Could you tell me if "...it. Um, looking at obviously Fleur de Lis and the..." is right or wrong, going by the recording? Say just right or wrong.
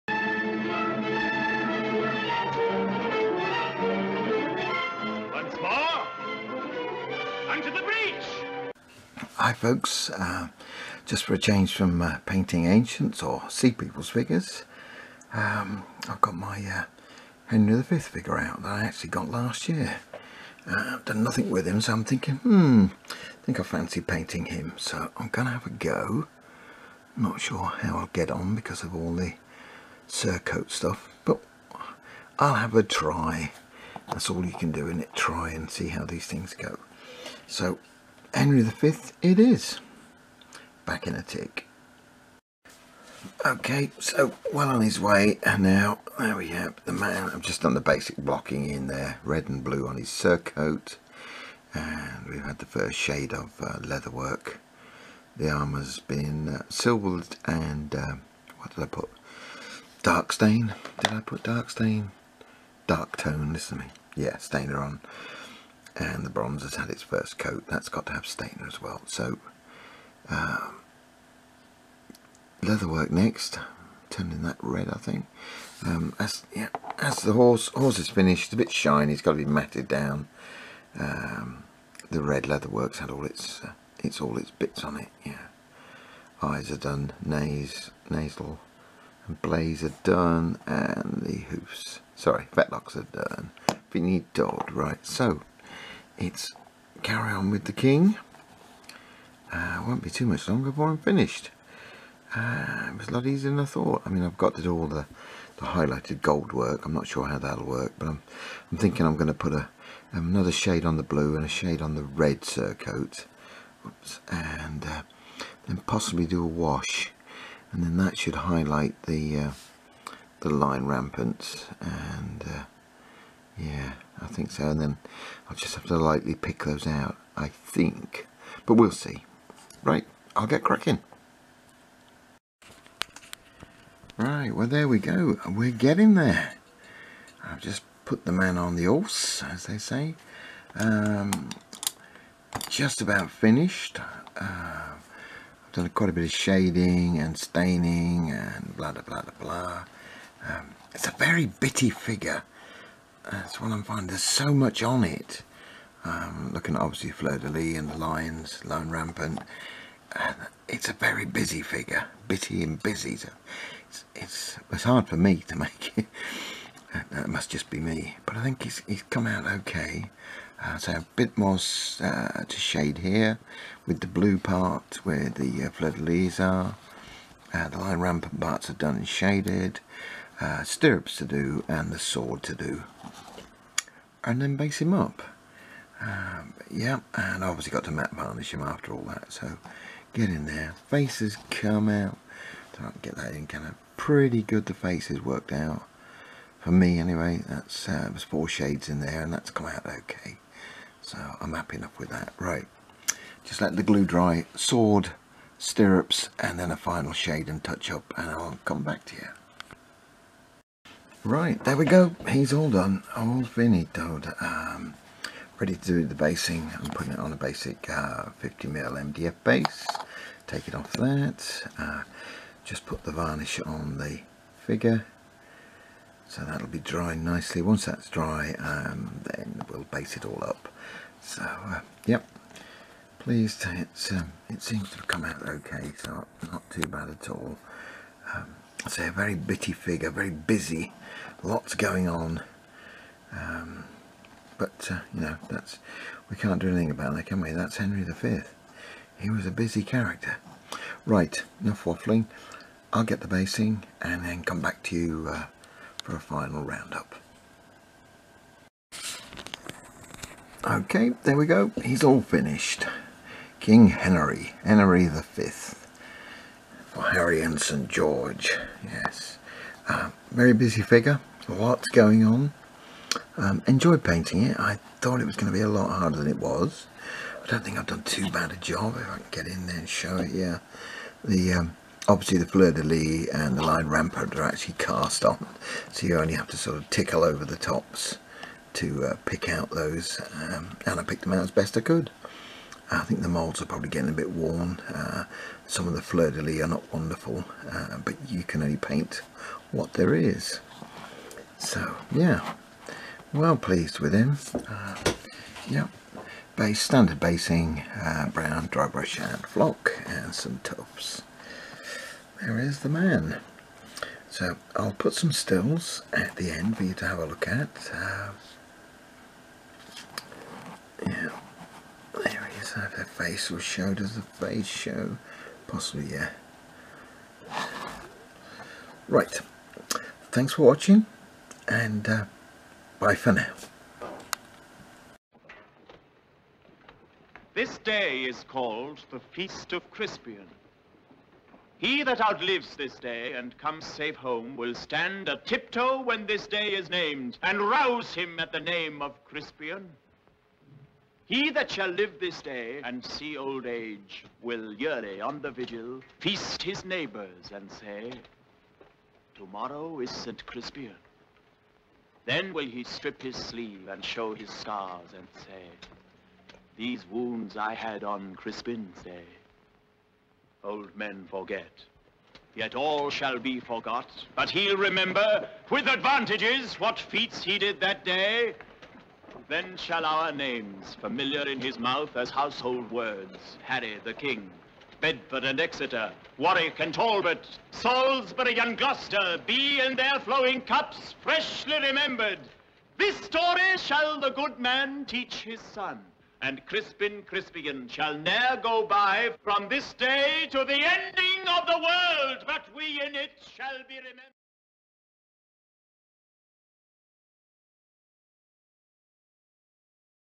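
right.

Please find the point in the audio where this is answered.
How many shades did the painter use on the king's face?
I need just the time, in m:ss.
3:18.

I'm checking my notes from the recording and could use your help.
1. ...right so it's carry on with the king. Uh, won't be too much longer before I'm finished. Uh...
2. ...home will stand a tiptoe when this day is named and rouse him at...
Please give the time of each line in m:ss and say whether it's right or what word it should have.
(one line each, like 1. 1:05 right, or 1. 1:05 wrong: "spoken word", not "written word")
1. 1:34 right
2. 5:44 right.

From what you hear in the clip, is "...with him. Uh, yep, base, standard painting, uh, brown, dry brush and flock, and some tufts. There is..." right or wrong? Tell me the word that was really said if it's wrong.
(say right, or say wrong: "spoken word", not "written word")
wrong: "basing", not "painting".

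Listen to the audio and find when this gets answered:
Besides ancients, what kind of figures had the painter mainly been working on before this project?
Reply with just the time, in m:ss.
0:13.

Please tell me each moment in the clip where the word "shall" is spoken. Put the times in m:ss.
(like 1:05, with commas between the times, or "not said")
5:51, 6:13, 6:19, 6:33, 6:37, 6:43.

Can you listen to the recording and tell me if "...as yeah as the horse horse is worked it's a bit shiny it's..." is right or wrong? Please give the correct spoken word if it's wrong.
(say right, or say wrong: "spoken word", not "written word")
wrong: "finished", not "worked".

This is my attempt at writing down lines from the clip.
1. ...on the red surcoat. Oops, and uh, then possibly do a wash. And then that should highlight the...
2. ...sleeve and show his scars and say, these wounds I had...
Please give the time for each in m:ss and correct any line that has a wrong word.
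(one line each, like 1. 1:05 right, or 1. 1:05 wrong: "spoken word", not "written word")
1. 1:51 right
2. 6:03 right.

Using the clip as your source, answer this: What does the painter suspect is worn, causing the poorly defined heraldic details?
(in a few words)
The molds.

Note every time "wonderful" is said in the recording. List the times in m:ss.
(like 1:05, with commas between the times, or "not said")
4:56.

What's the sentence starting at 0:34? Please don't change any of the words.
That's all you can do in it, try and see how these things go.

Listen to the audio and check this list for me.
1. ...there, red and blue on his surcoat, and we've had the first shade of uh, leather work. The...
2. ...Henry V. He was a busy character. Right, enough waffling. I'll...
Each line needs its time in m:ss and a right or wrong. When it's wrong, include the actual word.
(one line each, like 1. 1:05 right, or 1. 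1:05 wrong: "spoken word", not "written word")
1. 0:48 right
2. 4:07 right.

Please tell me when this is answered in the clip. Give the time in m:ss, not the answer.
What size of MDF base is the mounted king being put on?
3:37.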